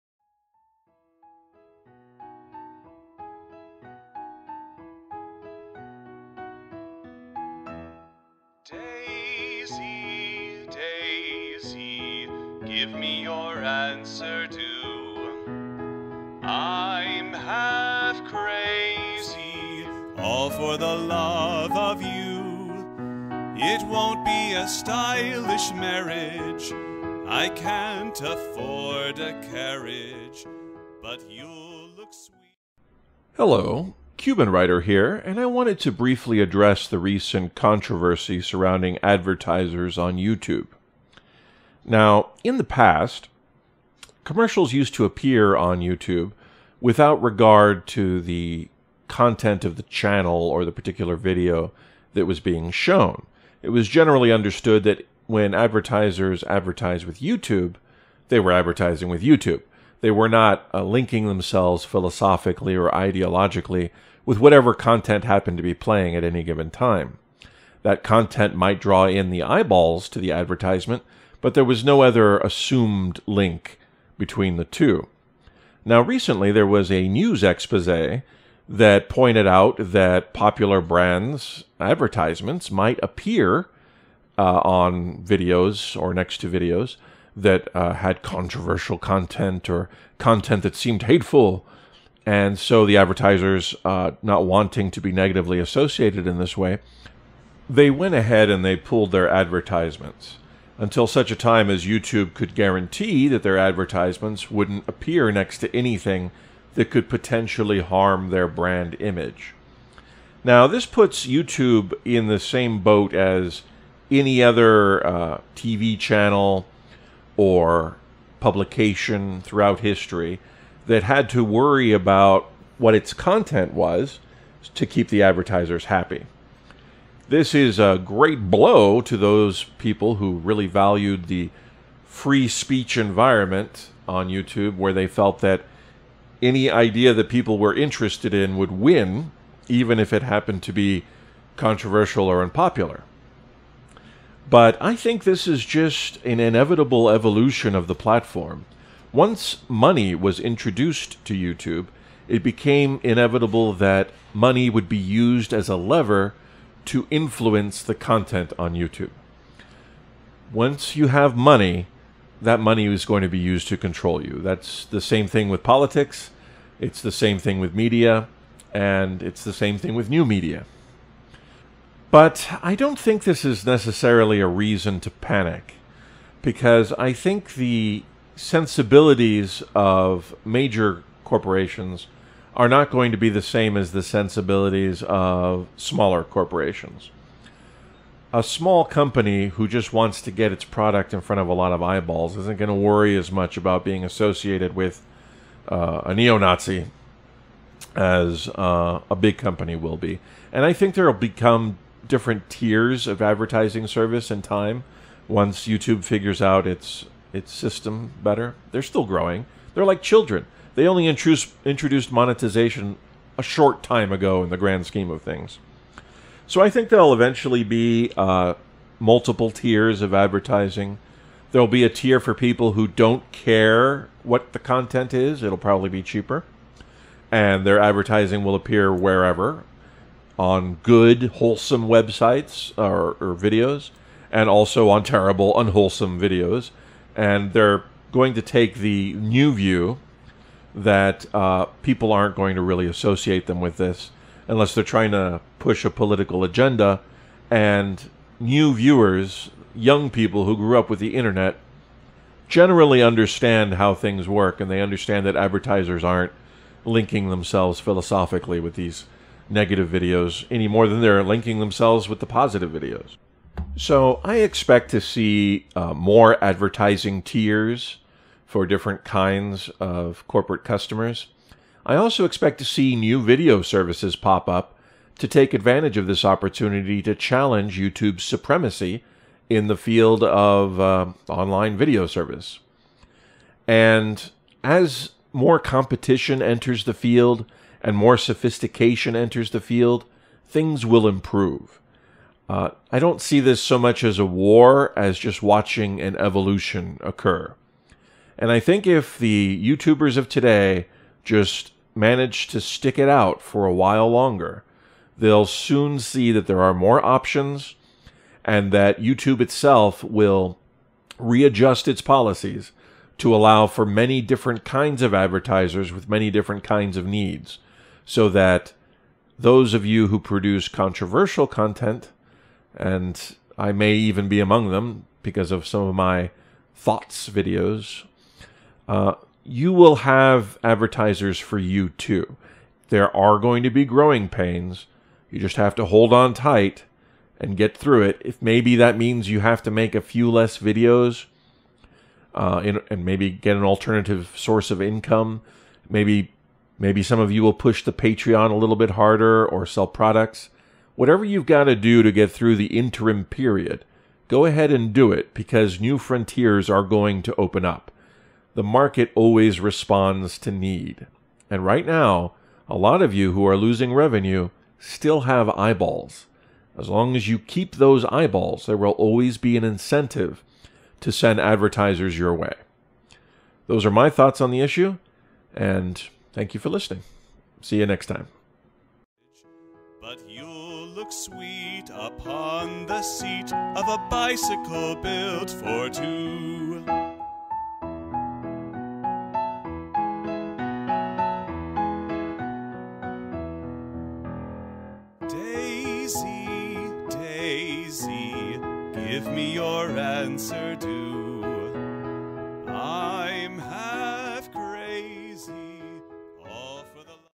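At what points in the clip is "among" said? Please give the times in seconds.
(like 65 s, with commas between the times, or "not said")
324 s.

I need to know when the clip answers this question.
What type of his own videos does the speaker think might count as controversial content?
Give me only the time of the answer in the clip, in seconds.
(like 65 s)
326 s.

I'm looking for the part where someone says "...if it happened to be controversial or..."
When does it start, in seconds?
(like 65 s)
139 s.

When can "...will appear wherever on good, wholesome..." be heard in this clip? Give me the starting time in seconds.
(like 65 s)
228 s.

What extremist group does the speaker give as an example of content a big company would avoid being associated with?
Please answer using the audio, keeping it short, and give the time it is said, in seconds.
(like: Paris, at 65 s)
neo Nazi, at 196 s.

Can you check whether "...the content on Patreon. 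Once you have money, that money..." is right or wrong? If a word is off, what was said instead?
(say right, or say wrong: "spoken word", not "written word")
wrong: "YouTube", not "Patreon".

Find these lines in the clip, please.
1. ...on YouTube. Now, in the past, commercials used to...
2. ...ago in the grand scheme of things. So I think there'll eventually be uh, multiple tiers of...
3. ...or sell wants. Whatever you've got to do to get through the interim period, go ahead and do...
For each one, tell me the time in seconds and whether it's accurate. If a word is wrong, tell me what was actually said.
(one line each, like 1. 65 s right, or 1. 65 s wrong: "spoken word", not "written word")
1. 39 s right
2. 214 s right
3. 349 s wrong: "products", not "wants".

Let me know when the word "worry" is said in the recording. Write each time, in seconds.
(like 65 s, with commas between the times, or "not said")
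121 s, 192 s.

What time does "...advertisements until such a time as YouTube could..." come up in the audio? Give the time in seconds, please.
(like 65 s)
99 s.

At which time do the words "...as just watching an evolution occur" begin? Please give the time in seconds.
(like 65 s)
294 s.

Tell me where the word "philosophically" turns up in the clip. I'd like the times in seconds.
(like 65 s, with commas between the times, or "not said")
61 s, 257 s.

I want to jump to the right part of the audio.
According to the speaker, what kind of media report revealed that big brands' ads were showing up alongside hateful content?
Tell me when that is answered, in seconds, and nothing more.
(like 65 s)
77 s.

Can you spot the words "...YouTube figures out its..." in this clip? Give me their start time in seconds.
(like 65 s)
205 s.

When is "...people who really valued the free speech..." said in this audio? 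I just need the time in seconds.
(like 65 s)
129 s.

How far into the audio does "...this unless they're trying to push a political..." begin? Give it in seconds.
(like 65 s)
243 s.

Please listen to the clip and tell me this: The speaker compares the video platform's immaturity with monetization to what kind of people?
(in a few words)
children.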